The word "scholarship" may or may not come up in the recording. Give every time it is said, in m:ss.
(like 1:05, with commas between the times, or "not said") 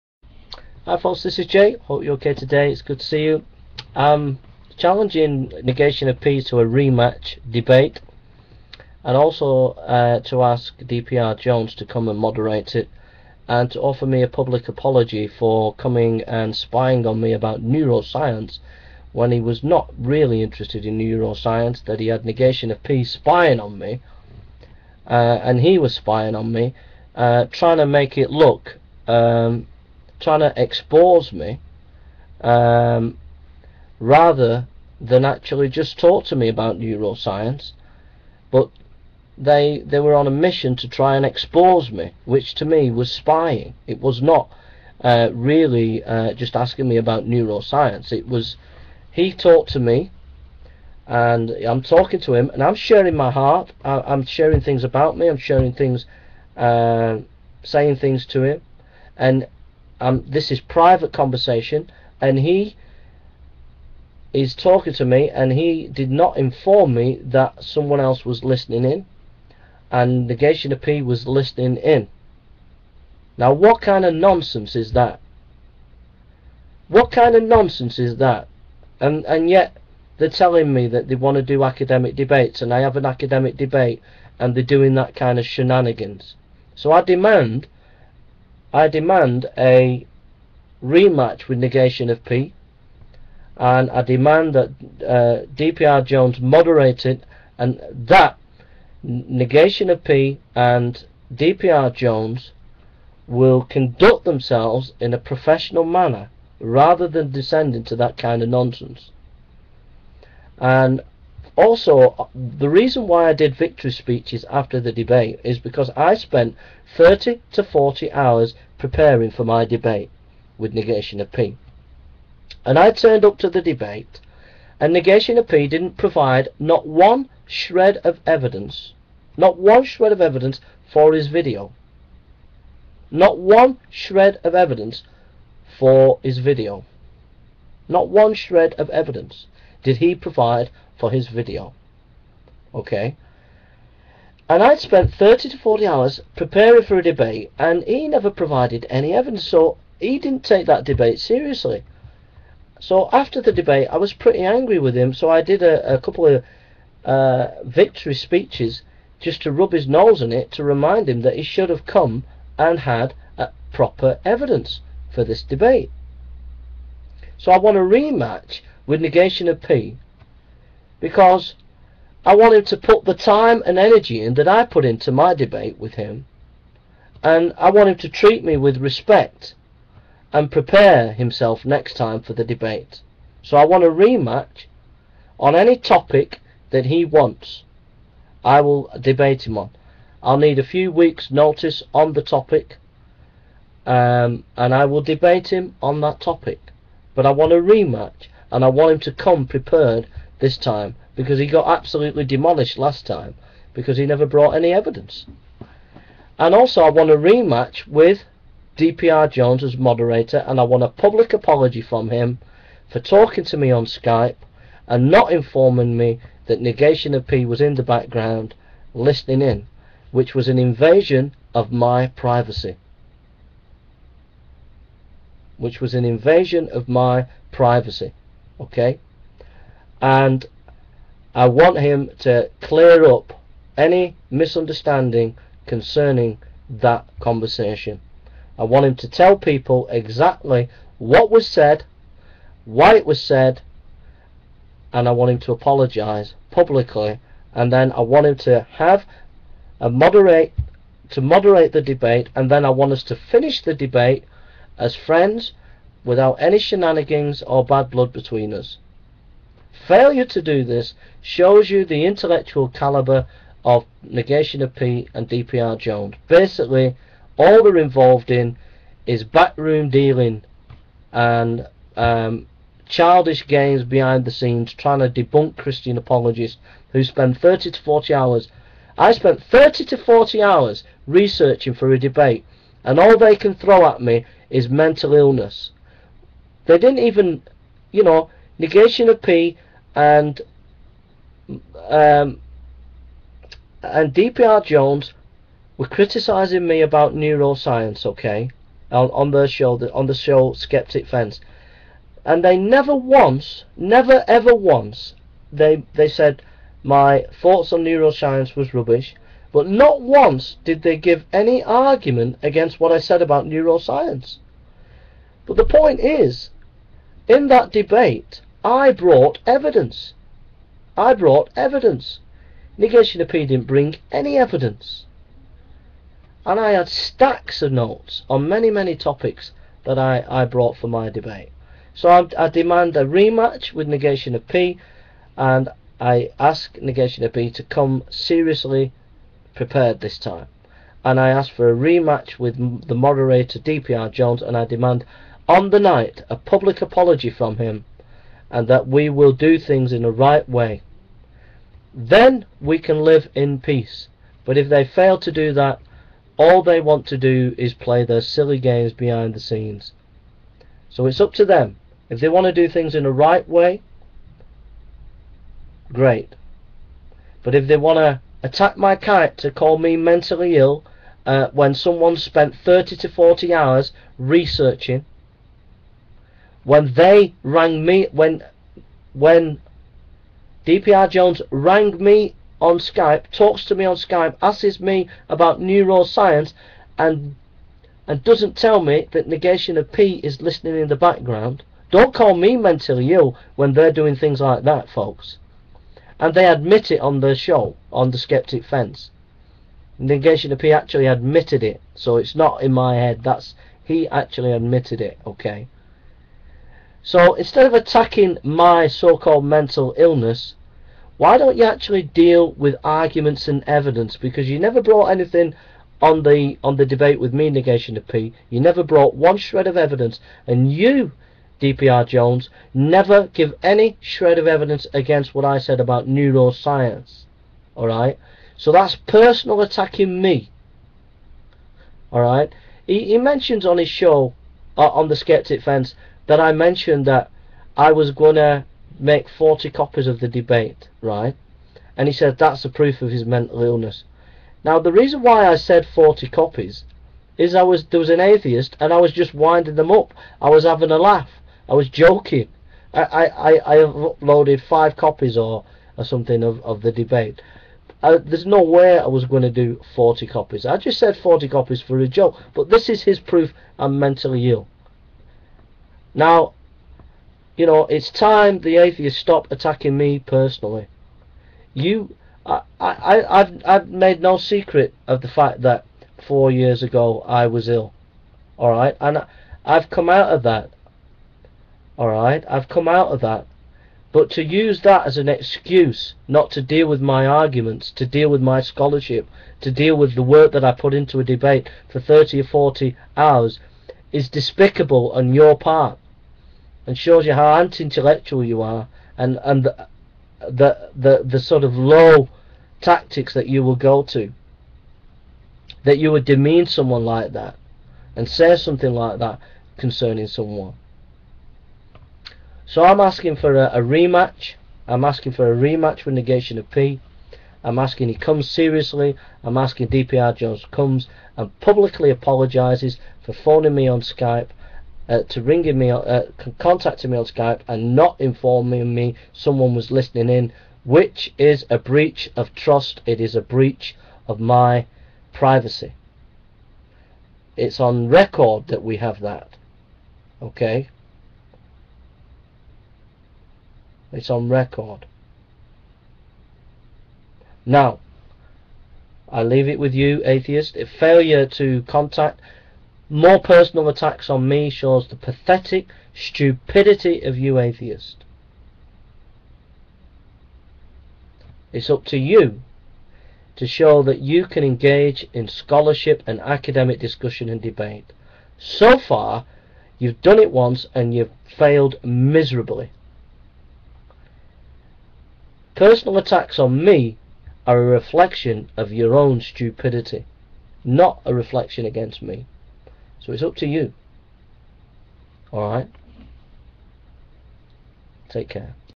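8:08, 9:25.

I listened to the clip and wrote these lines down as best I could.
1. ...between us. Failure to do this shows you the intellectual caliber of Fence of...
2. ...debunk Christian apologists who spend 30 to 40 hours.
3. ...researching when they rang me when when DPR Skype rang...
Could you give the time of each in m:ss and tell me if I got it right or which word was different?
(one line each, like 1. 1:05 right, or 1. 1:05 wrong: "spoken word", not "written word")
1. 4:18 wrong: "Negation", not "Fence"
2. 4:35 right
3. 6:14 wrong: "Jones", not "Skype".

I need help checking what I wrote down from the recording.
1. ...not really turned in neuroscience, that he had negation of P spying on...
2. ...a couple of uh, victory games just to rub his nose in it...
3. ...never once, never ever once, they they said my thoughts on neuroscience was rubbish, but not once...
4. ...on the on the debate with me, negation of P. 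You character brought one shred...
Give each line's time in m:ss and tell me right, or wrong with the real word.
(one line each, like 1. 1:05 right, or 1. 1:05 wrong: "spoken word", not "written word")
1. 0:19 wrong: "interested", not "turned"
2. 2:35 wrong: "speeches", not "games"
3. 5:02 right
4. 6:56 wrong: "never", not "character".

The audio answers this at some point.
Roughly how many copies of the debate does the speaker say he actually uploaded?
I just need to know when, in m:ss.
7:34.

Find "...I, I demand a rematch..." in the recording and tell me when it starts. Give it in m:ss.
5:32.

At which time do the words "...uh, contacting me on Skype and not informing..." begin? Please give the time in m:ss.
8:45.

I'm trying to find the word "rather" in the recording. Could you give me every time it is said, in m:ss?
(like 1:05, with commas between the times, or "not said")
0:33, 1:46.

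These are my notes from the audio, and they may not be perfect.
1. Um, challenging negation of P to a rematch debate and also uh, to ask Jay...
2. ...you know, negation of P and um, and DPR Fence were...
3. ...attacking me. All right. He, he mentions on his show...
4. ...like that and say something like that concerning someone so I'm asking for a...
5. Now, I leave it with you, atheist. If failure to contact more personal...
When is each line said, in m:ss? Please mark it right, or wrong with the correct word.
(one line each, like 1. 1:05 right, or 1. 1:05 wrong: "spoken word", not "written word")
1. 0:03 wrong: "DPR", not "Jay"
2. 4:47 wrong: "Jones", not "Fence"
3. 7:09 right
4. 8:27 right
5. 9:07 right.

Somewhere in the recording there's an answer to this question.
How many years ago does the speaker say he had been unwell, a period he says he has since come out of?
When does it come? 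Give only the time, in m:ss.
7:56.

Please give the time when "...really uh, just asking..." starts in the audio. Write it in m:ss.
0:45.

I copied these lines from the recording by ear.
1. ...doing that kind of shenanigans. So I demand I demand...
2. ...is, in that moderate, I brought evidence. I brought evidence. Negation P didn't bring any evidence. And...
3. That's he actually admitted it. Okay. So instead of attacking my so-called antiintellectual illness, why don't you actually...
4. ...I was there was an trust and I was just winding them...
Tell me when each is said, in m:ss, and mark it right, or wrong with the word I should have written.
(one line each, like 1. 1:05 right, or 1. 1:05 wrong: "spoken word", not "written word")
1. 1:24 right
2. 5:15 wrong: "debate", not "moderate"
3. 6:43 wrong: "mental", not "antiintellectual"
4. 7:27 wrong: "atheist", not "trust".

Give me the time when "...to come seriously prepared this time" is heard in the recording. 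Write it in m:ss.
5:37.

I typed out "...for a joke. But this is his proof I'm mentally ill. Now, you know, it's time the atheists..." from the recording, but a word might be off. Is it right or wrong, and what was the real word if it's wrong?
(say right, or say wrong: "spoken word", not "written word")
right.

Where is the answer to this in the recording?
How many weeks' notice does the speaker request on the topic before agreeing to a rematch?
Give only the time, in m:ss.
3:10.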